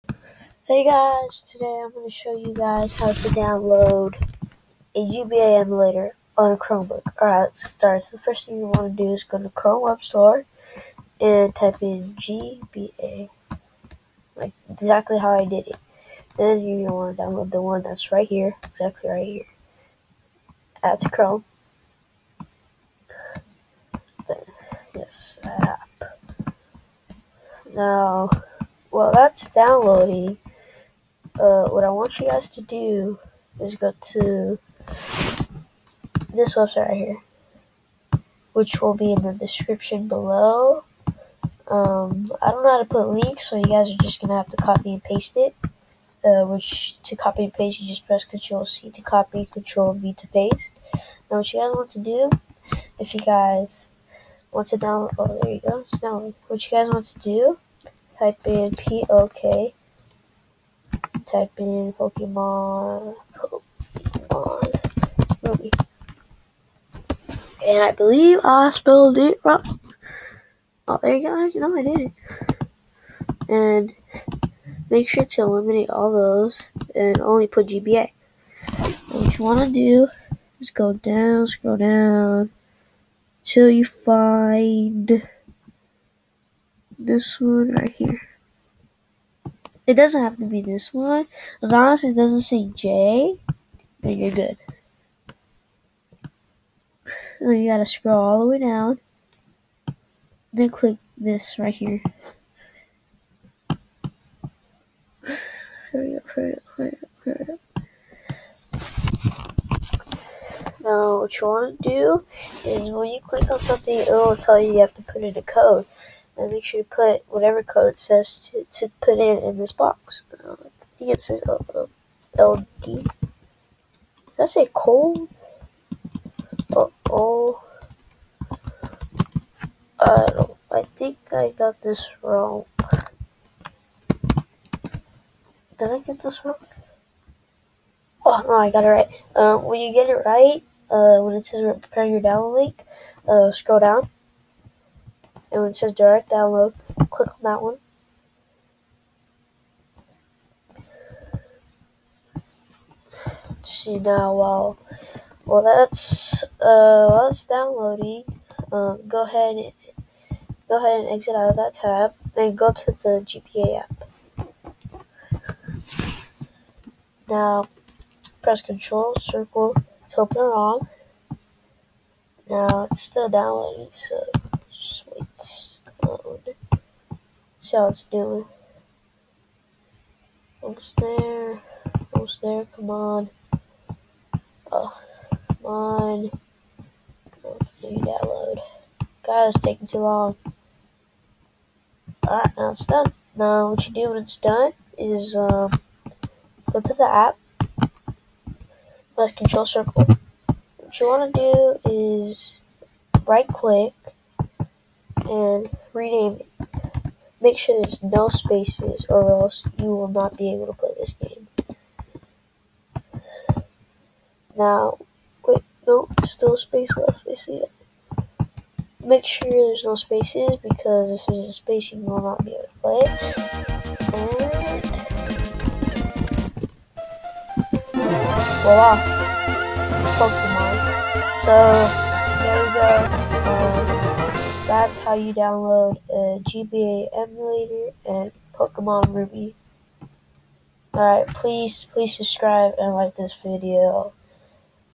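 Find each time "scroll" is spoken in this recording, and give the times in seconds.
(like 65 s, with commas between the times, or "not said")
81 s, 97 s, 143 s.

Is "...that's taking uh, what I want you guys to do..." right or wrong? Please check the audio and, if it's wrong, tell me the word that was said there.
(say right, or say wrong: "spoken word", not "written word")
wrong: "downloading", not "taking".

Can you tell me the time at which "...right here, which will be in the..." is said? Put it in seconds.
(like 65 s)
36 s.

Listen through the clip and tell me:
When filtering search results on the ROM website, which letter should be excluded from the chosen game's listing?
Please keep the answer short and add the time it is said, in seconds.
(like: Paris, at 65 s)
J, at 92 s.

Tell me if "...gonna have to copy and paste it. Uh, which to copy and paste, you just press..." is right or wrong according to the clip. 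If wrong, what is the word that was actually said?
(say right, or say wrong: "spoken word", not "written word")
right.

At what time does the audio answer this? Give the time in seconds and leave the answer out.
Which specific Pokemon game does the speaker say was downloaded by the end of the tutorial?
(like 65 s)
238 s.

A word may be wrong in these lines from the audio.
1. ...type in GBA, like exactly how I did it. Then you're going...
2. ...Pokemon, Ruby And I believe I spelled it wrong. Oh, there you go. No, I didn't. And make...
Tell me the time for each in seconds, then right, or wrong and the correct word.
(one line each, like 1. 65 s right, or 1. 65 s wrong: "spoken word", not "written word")
1. 11 s right
2. 61 s wrong: "Pokemon", not "Ruby".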